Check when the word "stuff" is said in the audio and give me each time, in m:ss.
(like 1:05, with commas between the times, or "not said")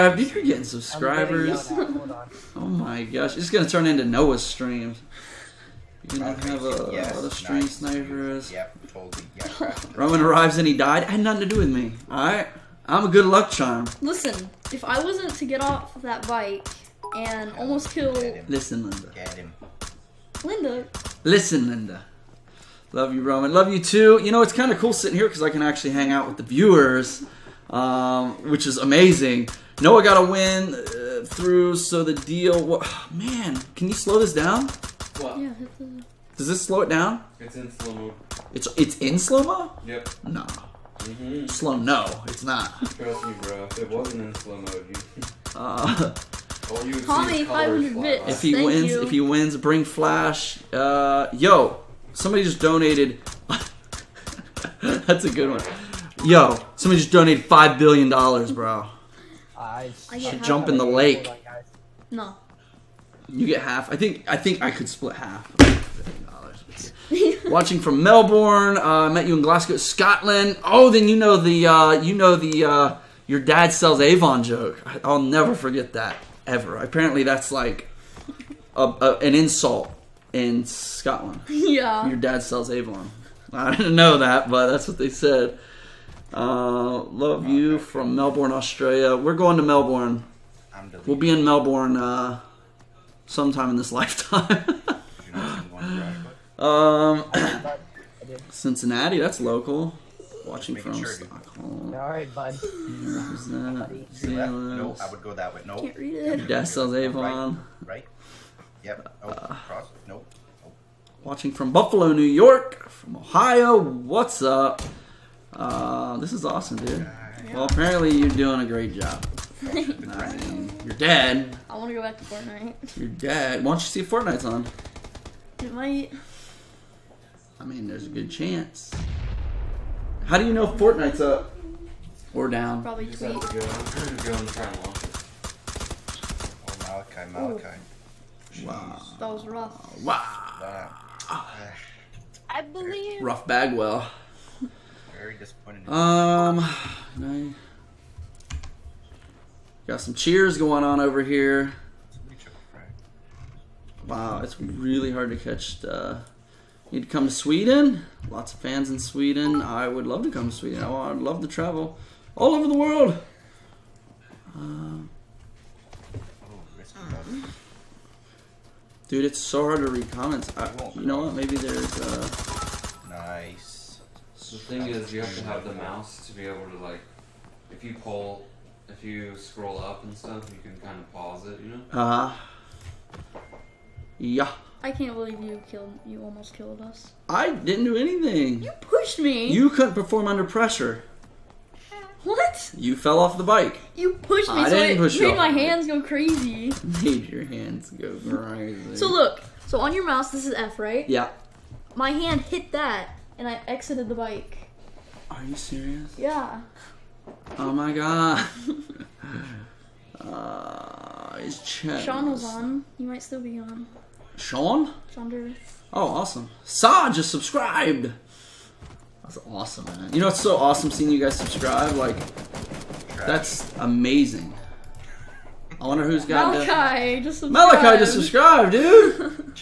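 3:00.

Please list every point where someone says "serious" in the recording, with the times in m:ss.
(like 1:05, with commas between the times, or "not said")
3:25.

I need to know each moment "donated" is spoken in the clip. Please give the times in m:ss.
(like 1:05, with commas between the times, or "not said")
0:52, 0:57.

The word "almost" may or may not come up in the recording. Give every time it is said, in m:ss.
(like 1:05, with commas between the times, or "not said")
0:17, 3:06.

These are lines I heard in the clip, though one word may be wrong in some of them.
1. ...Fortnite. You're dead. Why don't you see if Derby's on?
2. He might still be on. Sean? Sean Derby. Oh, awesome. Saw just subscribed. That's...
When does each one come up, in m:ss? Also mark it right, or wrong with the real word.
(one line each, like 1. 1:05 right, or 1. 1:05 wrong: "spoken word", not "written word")
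1. 2:02 wrong: "Fortnite", not "Derby"
2. 3:32 right.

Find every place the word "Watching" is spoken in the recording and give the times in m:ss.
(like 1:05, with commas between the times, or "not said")
1:07, 1:40, 1:51.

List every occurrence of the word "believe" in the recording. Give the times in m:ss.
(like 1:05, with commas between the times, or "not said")
2:22, 3:05.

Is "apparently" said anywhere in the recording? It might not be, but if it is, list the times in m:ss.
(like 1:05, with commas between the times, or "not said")
1:16, 1:57.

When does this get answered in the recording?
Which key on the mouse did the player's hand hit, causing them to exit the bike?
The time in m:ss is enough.
3:20.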